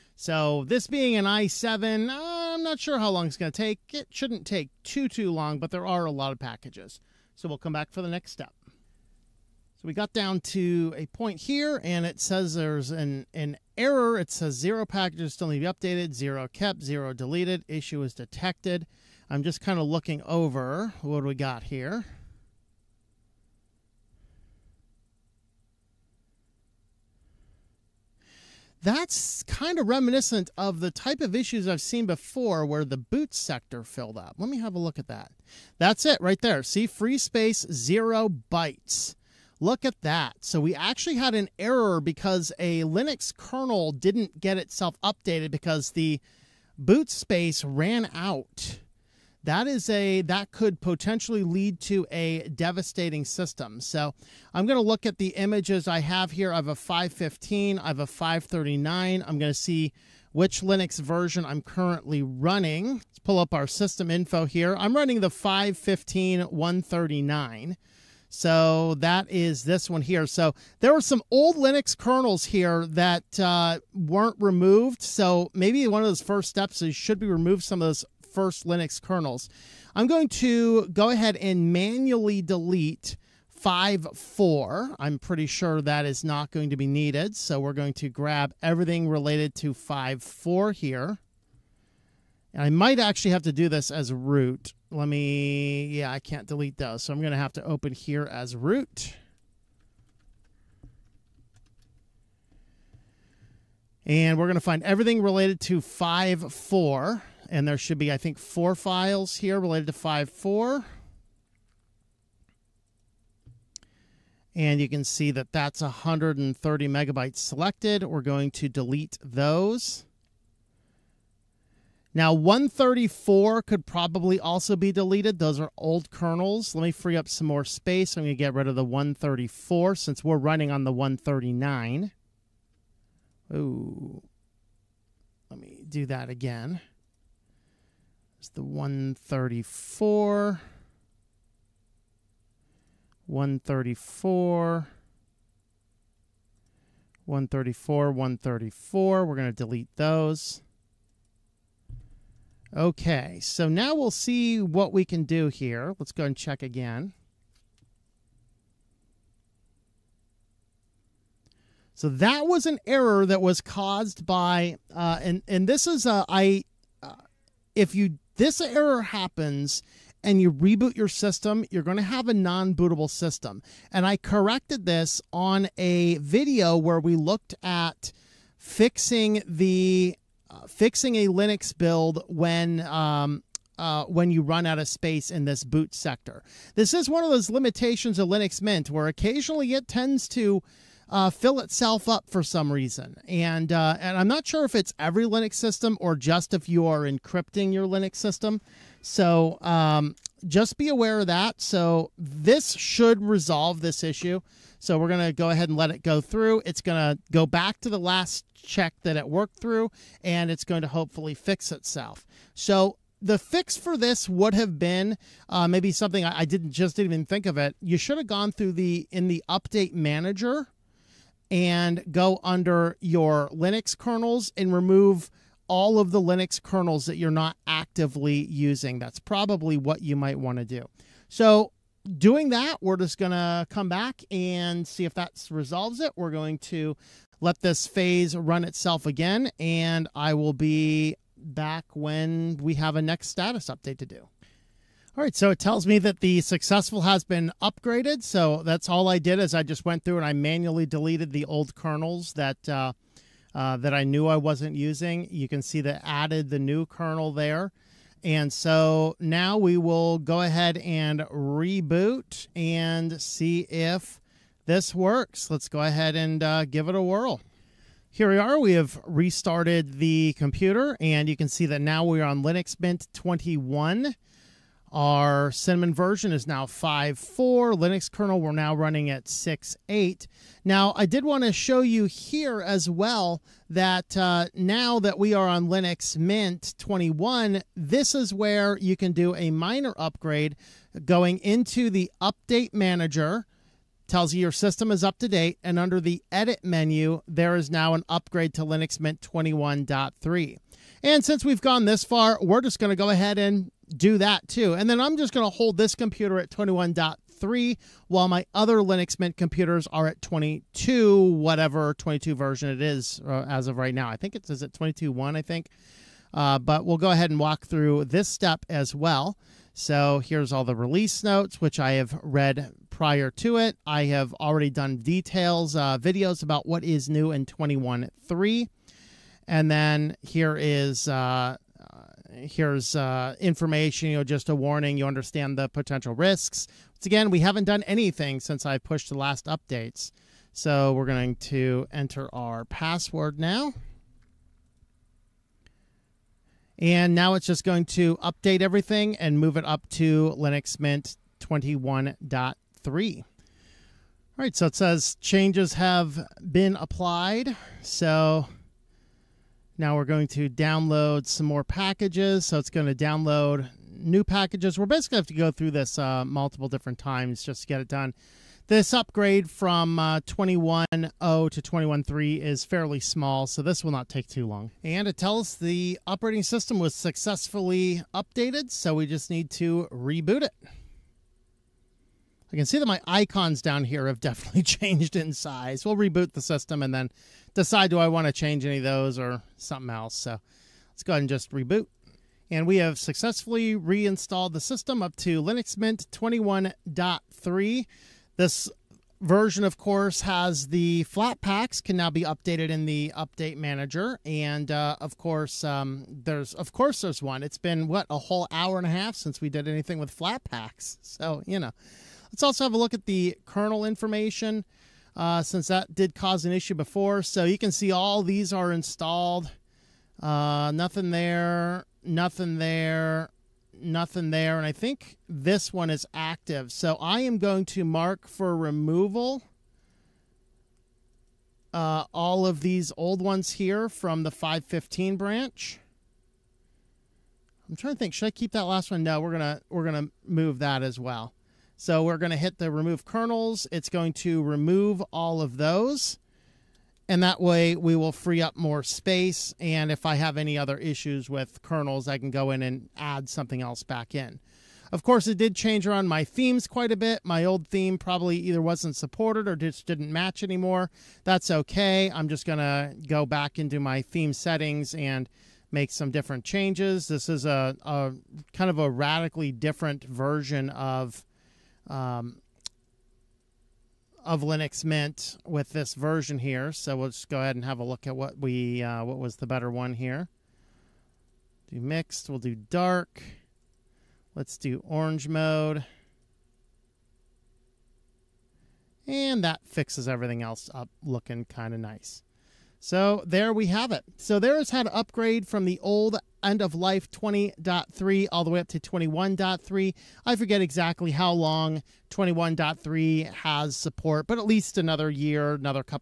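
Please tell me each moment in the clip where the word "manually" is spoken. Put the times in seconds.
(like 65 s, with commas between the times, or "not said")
81 s, 250 s.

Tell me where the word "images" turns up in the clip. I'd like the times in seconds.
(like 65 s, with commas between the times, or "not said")
55 s.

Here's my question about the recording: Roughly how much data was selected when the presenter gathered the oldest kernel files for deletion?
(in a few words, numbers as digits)
130 megabytes.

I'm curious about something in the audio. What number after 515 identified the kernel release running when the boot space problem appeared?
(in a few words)
139.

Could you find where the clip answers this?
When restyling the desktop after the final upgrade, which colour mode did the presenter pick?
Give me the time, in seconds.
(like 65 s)
484 s.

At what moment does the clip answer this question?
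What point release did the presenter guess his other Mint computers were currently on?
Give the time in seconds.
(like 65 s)
314 s.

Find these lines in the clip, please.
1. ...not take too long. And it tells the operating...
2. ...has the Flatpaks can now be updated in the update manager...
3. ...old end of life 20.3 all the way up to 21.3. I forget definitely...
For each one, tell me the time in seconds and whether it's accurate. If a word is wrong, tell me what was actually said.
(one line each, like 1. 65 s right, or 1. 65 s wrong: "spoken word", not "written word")
1. 373 s right
2. 400 s right
3. 495 s wrong: "exactly", not "definitely".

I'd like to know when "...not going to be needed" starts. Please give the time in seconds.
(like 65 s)
86 s.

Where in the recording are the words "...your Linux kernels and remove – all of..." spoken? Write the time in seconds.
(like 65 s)
222 s.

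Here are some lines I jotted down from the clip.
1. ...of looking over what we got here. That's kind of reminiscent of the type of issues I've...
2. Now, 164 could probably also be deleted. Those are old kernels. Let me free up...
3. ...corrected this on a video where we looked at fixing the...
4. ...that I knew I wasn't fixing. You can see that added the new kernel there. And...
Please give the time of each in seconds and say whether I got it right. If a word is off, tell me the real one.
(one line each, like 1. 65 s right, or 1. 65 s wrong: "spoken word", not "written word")
1. 19 s right
2. 122 s wrong: "134", not "164"
3. 174 s right
4. 253 s wrong: "using", not "fixing".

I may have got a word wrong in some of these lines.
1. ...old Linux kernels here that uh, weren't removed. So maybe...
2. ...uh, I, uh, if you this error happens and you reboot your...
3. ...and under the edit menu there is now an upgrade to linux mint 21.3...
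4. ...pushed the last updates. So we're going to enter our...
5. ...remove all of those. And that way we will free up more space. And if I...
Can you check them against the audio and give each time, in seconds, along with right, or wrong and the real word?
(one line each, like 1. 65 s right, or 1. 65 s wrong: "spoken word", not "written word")
1. 71 s right
2. 166 s right
3. 295 s right
4. 338 s right
5. 444 s right.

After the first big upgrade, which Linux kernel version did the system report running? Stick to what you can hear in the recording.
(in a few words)
6.8.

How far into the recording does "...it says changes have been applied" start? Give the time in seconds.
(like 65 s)
354 s.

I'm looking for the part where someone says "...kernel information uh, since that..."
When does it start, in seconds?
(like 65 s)
413 s.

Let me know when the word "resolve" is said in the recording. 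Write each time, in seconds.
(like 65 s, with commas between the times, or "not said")
203 s, 235 s.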